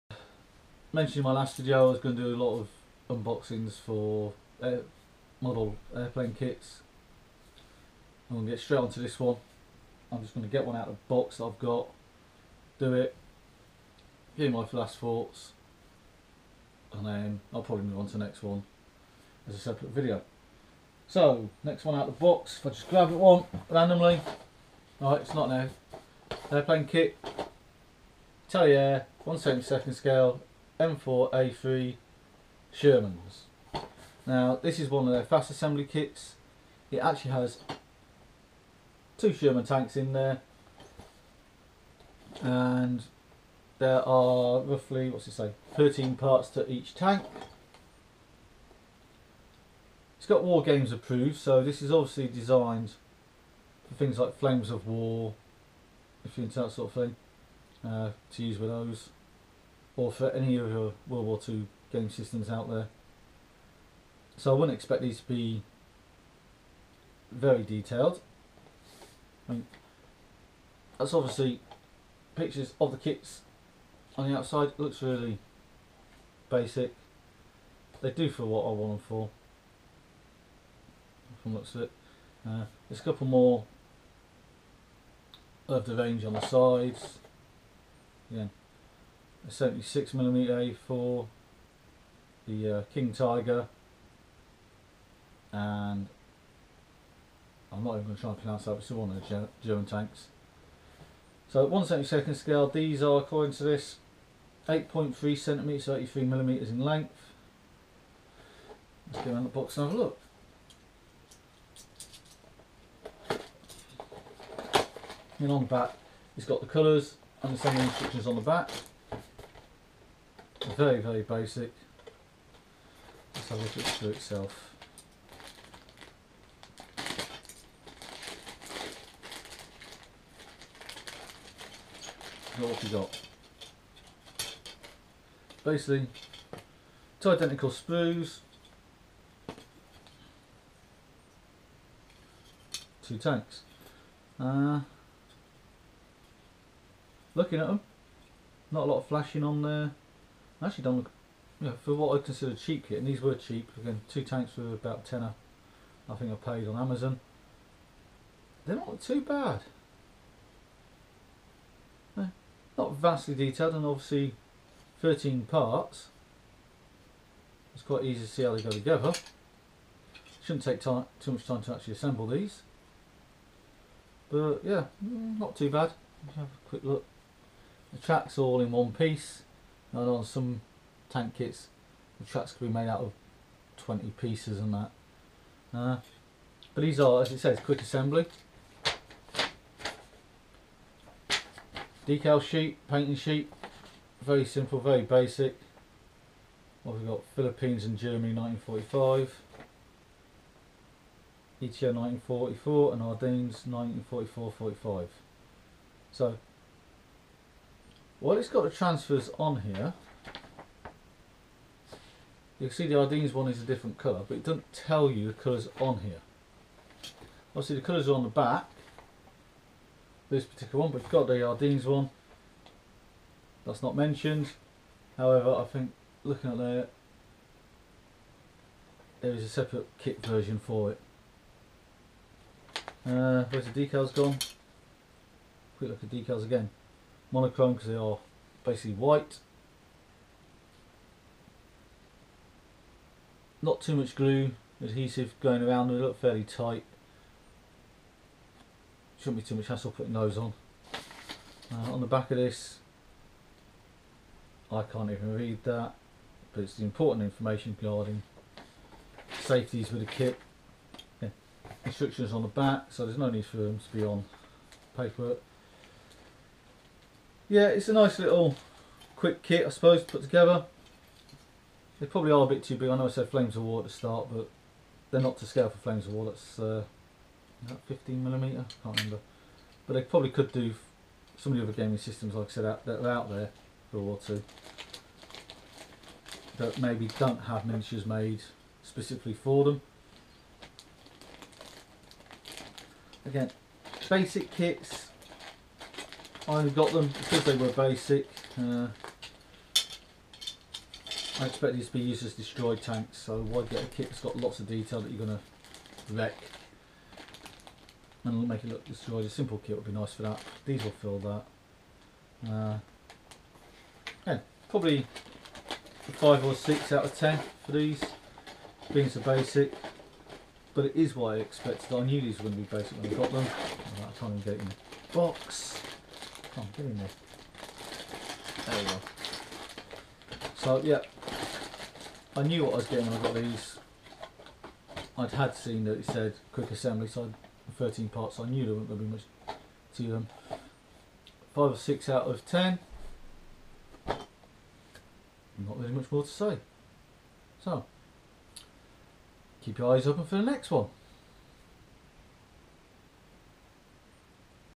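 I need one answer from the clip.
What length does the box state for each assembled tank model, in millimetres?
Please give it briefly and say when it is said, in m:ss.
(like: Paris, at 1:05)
83 millimetres, at 1:45.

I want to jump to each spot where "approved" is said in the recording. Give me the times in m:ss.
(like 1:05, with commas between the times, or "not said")
0:50.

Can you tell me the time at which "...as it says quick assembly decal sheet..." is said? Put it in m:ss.
3:07.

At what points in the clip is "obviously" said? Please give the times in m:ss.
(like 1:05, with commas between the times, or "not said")
0:51, 1:11, 2:43, 3:37.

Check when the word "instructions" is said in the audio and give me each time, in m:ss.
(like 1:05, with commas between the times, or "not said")
1:57, 4:21.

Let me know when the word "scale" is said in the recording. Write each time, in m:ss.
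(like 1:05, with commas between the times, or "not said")
0:29, 1:42, 4:35.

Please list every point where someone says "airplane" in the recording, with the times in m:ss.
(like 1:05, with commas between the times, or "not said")
0:05, 0:26.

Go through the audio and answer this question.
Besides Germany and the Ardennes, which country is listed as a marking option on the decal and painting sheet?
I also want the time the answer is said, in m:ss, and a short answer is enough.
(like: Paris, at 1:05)
Philippines, at 3:17.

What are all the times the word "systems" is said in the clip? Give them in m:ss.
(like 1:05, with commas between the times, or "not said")
1:02, 4:41.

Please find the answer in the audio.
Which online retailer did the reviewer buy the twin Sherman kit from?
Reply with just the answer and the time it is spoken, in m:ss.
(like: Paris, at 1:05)
Amazon, at 2:36.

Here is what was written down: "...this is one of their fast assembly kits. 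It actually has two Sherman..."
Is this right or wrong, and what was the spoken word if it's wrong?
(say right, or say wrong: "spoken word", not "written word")
right.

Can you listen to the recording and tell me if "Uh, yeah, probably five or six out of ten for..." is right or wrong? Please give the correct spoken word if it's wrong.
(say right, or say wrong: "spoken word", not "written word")
right.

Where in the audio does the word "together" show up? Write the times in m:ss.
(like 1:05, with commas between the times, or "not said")
2:48, 4:30.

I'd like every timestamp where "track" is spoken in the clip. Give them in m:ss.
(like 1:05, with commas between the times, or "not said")
2:57, 3:02.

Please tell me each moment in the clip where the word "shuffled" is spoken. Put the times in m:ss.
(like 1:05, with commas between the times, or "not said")
not said.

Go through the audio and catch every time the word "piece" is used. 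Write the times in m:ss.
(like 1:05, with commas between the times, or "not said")
2:58, 3:04.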